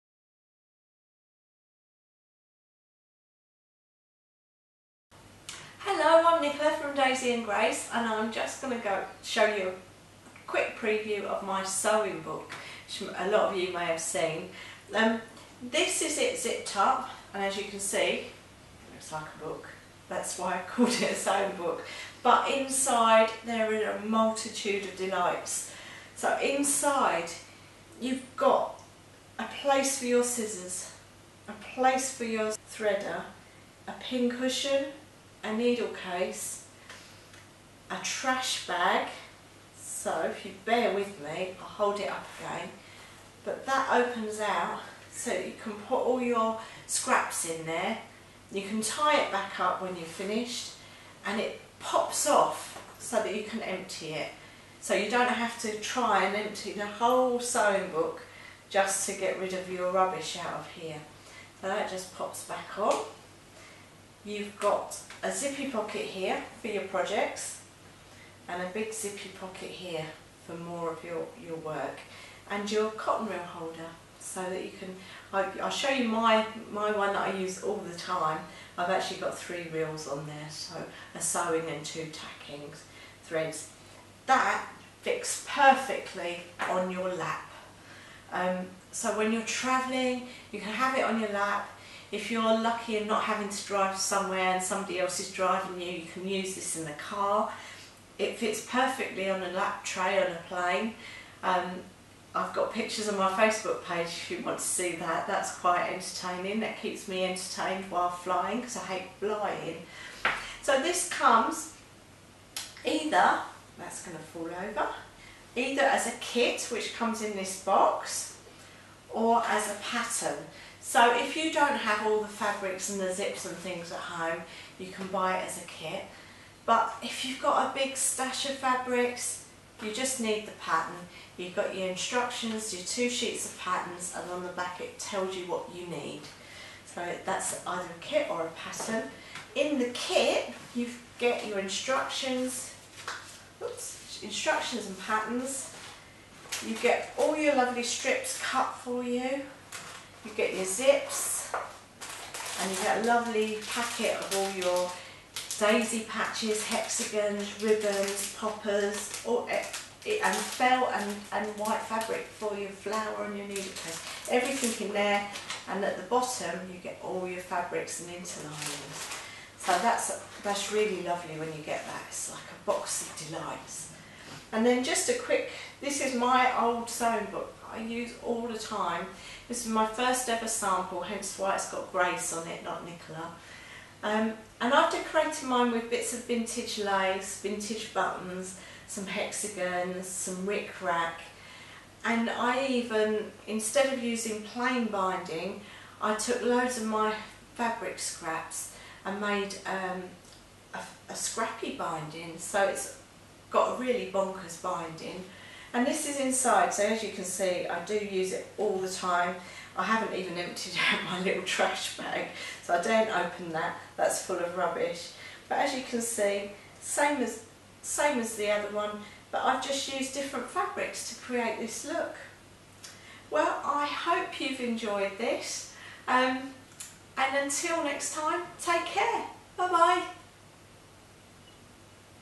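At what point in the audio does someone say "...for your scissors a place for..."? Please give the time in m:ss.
0:29.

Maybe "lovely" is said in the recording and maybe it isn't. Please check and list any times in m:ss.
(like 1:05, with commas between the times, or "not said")
2:27, 2:33, 2:51.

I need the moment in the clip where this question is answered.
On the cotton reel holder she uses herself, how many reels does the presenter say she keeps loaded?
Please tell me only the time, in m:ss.
1:19.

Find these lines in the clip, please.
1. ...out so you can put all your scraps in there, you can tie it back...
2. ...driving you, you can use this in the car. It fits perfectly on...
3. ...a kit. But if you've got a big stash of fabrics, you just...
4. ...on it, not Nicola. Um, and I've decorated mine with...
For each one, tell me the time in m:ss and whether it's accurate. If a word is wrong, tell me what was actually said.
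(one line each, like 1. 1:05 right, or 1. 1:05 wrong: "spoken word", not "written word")
1. 0:44 right
2. 1:35 right
3. 2:05 right
4. 3:02 right.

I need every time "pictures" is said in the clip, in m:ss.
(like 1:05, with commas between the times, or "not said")
1:42.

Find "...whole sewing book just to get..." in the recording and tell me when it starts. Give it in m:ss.
0:56.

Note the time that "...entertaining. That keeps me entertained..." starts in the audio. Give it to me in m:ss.
1:45.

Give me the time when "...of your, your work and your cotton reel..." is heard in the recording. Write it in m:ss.
1:10.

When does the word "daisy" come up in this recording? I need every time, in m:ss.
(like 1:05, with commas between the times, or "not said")
0:06, 2:35.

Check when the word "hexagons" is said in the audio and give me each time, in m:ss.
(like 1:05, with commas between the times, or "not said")
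2:36, 3:09.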